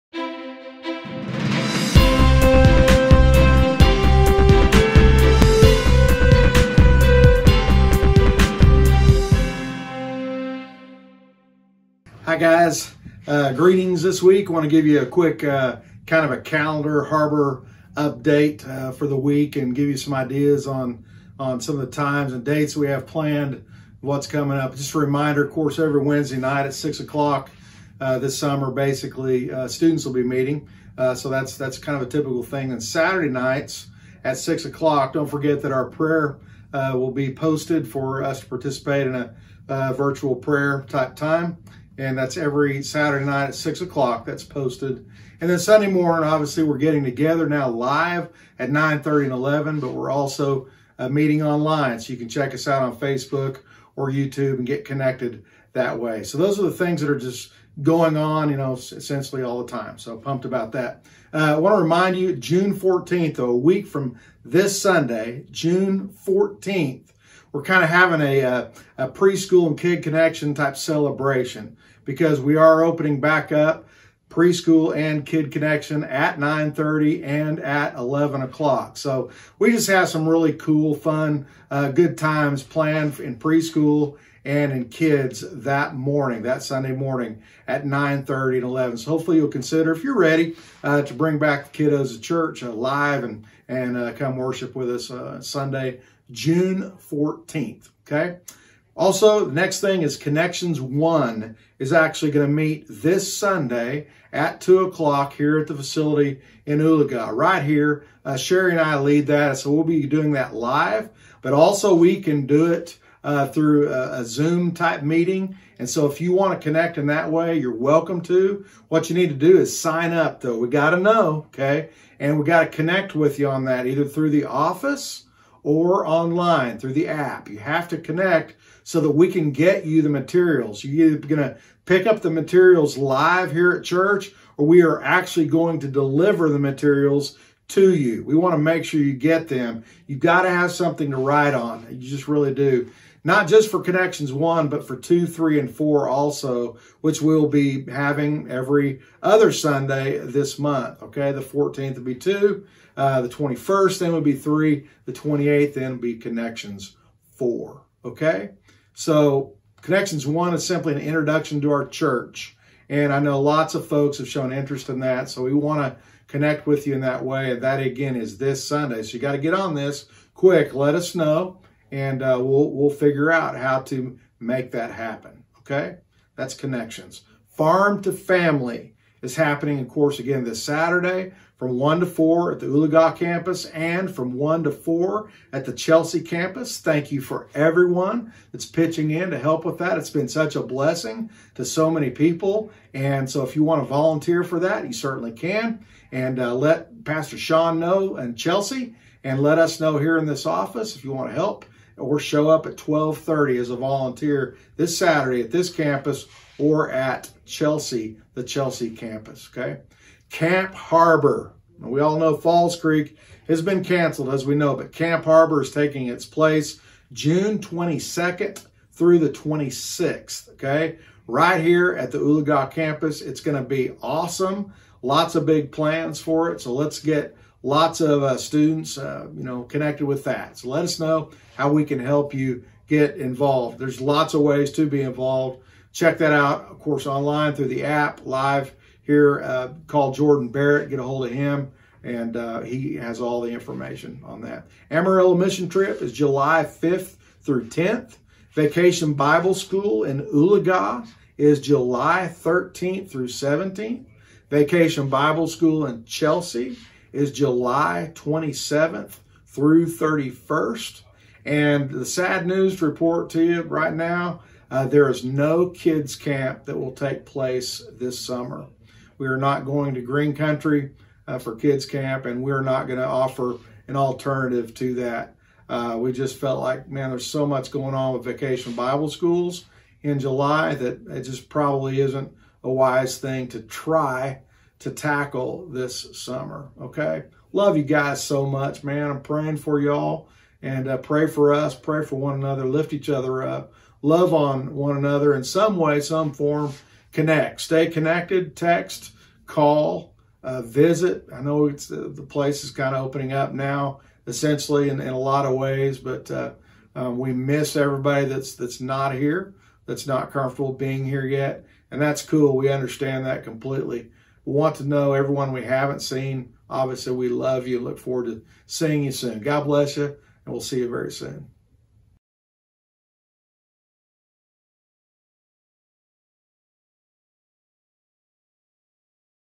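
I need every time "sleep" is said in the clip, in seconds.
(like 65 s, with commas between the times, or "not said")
not said.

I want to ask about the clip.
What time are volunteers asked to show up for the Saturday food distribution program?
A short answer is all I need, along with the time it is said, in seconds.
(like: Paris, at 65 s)
12:30, at 202 s.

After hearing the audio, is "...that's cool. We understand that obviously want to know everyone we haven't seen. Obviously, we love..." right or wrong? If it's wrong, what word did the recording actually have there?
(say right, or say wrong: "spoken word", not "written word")
wrong: "completely", not "obviously".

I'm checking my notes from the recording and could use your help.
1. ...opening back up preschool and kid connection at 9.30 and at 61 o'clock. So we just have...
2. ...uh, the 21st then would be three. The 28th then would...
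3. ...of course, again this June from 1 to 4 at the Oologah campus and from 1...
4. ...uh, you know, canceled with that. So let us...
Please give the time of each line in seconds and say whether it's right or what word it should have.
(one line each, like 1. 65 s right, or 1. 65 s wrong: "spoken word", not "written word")
1. 72 s wrong: "11", not "61"
2. 152 s right
3. 179 s wrong: "Saturday", not "June"
4. 228 s wrong: "connected", not "canceled".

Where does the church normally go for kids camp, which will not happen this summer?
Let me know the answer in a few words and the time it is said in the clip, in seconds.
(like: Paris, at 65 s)
Green Country, at 270 s.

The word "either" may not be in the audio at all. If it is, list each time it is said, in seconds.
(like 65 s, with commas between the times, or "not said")
123 s, 131 s.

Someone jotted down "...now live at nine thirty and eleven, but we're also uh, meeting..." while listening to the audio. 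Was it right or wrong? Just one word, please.
right.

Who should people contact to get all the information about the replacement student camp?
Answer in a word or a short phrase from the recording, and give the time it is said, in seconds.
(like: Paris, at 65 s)
Jordan Barrett, at 240 s.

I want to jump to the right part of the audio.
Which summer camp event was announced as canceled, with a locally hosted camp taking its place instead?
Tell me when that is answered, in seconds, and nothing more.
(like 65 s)
212 s.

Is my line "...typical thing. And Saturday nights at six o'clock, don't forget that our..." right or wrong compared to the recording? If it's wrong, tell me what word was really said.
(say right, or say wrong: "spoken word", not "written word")
right.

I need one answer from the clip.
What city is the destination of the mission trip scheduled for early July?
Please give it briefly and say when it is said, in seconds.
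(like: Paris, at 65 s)
Amarillo, at 244 s.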